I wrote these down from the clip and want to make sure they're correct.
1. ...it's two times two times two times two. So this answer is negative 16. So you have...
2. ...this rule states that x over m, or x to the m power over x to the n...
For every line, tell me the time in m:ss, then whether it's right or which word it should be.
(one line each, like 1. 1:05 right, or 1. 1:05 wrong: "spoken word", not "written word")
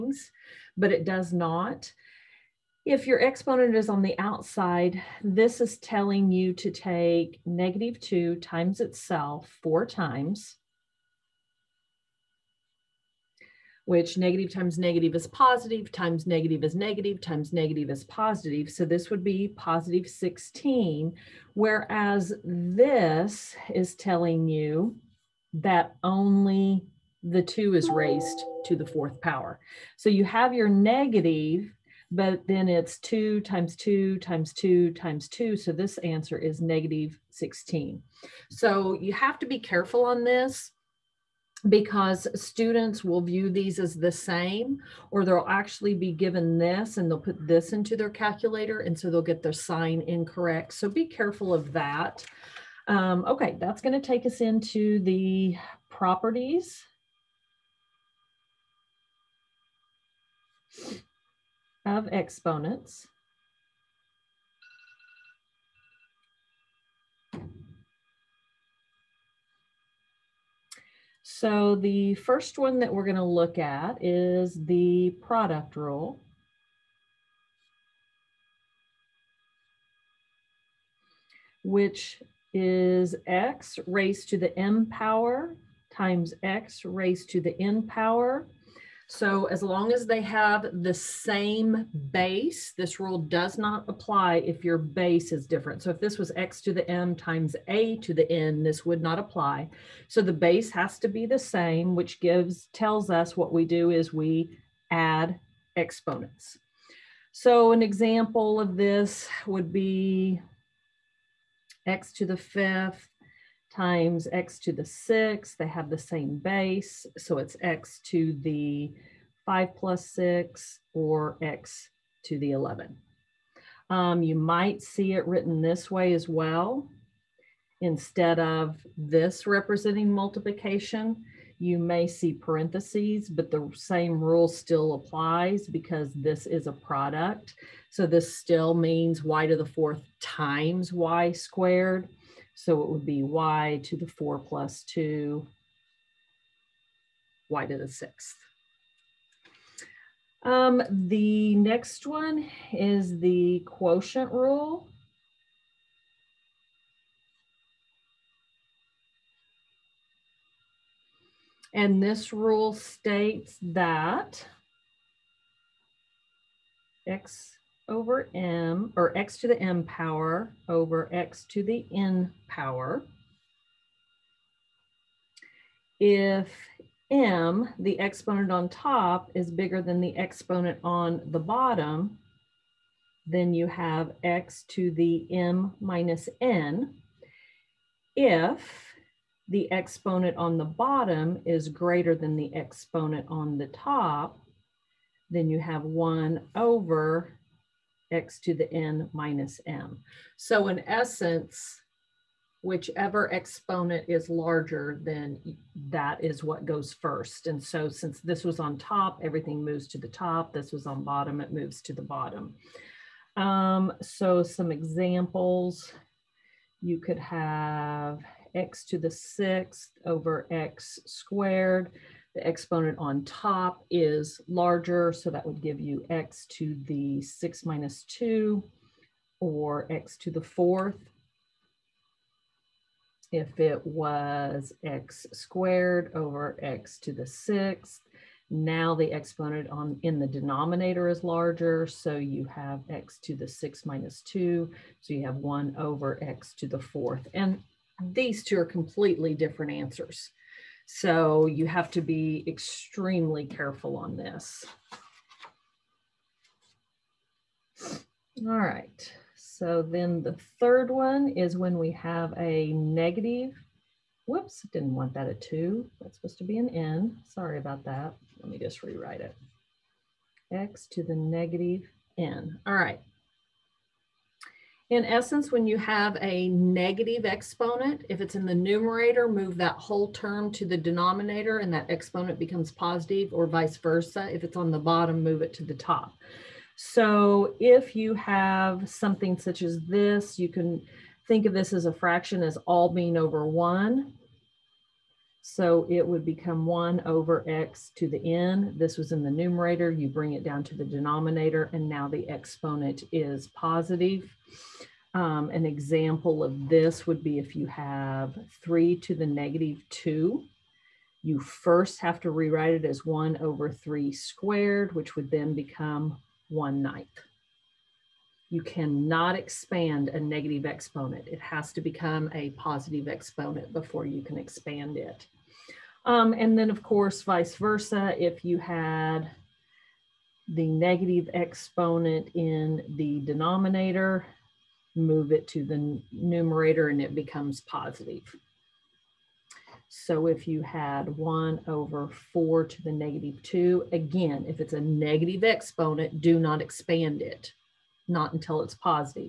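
1. 0:32 right
2. 2:41 right.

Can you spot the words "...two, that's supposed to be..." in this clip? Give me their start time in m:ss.
4:25.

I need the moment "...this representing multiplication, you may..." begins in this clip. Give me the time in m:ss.
2:08.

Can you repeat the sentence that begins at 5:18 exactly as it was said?
You cannot expand a negative exponent.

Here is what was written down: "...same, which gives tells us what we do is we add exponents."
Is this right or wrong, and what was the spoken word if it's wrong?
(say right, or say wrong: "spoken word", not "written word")
right.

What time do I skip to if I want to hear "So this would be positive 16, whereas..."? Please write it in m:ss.
0:18.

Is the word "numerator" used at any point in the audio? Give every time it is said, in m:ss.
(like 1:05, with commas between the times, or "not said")
4:38, 4:59, 5:36.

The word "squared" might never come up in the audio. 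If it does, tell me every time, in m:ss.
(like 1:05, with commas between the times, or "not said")
2:21, 3:41, 3:55, 5:14.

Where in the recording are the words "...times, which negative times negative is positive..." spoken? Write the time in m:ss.
0:09.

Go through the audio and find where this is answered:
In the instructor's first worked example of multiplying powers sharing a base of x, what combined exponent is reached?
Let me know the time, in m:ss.
2:01.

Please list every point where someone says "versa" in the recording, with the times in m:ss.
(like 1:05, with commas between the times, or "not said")
4:43, 5:27.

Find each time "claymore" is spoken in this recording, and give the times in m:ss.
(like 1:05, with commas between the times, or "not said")
not said.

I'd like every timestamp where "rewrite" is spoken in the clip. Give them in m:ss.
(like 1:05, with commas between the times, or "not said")
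4:28, 5:12.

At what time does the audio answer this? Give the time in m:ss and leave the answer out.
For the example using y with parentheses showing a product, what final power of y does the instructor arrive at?
2:27.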